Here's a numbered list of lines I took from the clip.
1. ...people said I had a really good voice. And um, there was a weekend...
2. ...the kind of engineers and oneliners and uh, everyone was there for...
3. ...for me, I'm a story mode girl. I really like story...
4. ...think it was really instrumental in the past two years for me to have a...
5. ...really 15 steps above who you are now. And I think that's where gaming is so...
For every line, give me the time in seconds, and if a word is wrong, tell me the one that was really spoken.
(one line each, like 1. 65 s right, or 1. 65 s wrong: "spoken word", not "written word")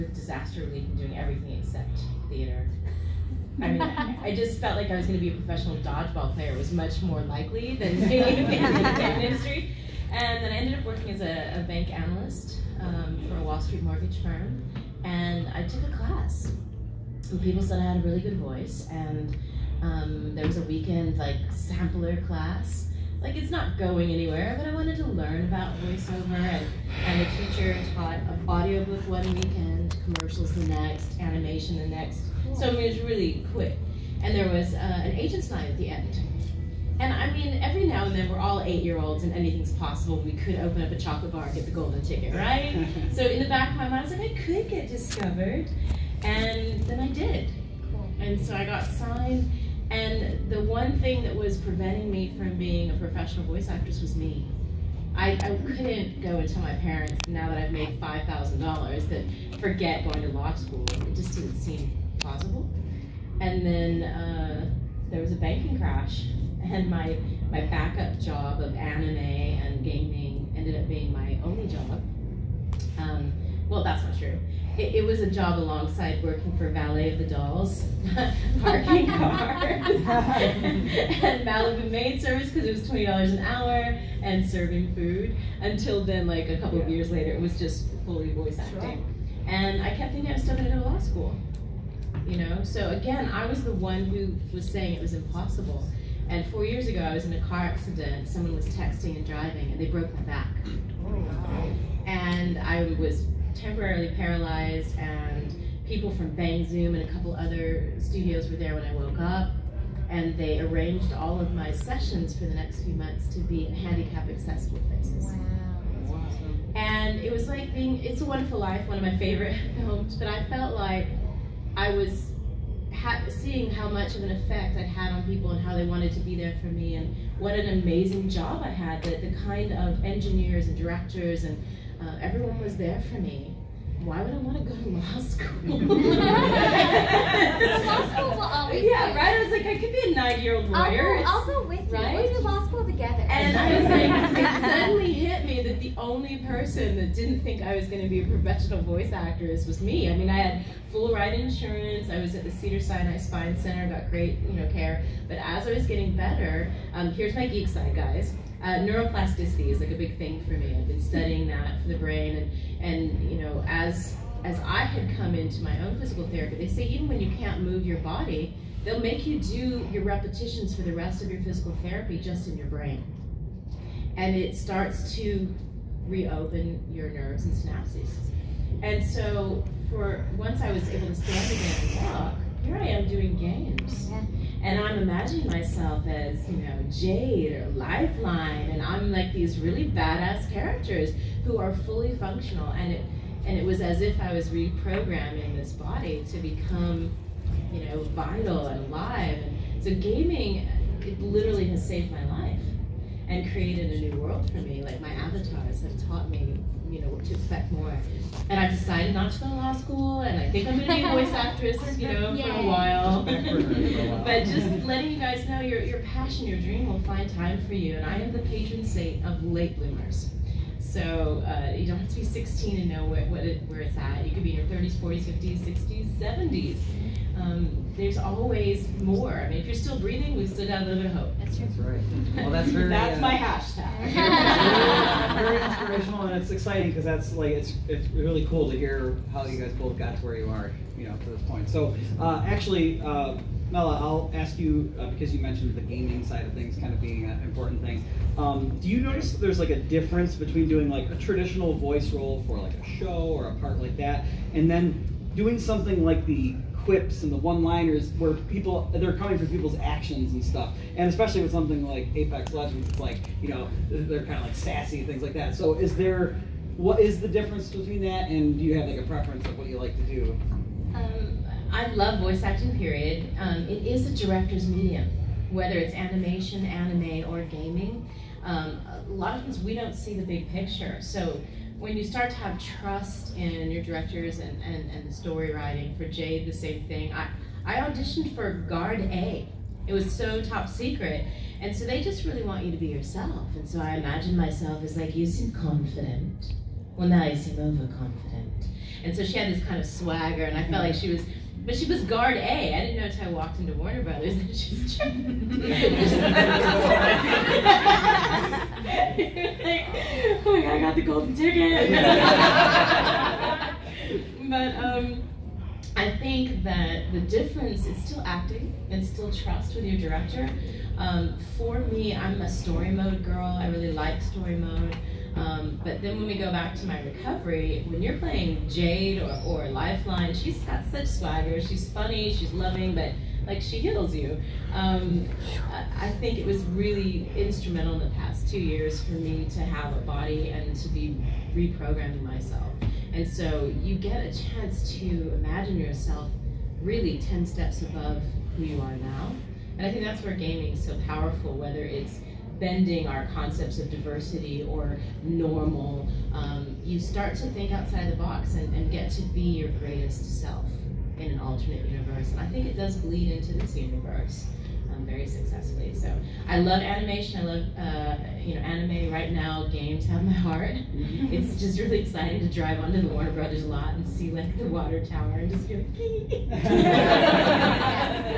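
1. 17 s right
2. 129 s wrong: "directors", not "oneliners"
3. 321 s right
4. 336 s right
5. 346 s wrong: "10", not "15".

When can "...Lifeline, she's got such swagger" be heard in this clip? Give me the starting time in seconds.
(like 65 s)
329 s.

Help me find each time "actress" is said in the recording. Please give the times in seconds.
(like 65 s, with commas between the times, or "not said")
53 s, 149 s, 211 s.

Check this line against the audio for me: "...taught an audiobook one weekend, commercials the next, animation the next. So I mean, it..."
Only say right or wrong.
right.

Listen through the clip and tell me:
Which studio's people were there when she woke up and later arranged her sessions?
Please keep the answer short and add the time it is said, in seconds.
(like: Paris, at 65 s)
Bang Zoom, at 106 s.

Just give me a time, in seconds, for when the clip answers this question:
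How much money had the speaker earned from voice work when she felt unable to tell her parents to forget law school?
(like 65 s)
57 s.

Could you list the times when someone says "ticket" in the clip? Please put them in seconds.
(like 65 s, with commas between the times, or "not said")
42 s, 311 s.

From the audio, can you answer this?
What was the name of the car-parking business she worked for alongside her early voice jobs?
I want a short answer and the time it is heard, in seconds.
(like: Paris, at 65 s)
Valet of the Dolls, at 76 s.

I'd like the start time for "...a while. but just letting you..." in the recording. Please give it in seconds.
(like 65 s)
212 s.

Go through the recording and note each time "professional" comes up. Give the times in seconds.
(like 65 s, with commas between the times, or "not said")
5 s, 52 s, 148 s.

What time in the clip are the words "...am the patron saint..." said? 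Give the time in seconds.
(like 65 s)
218 s.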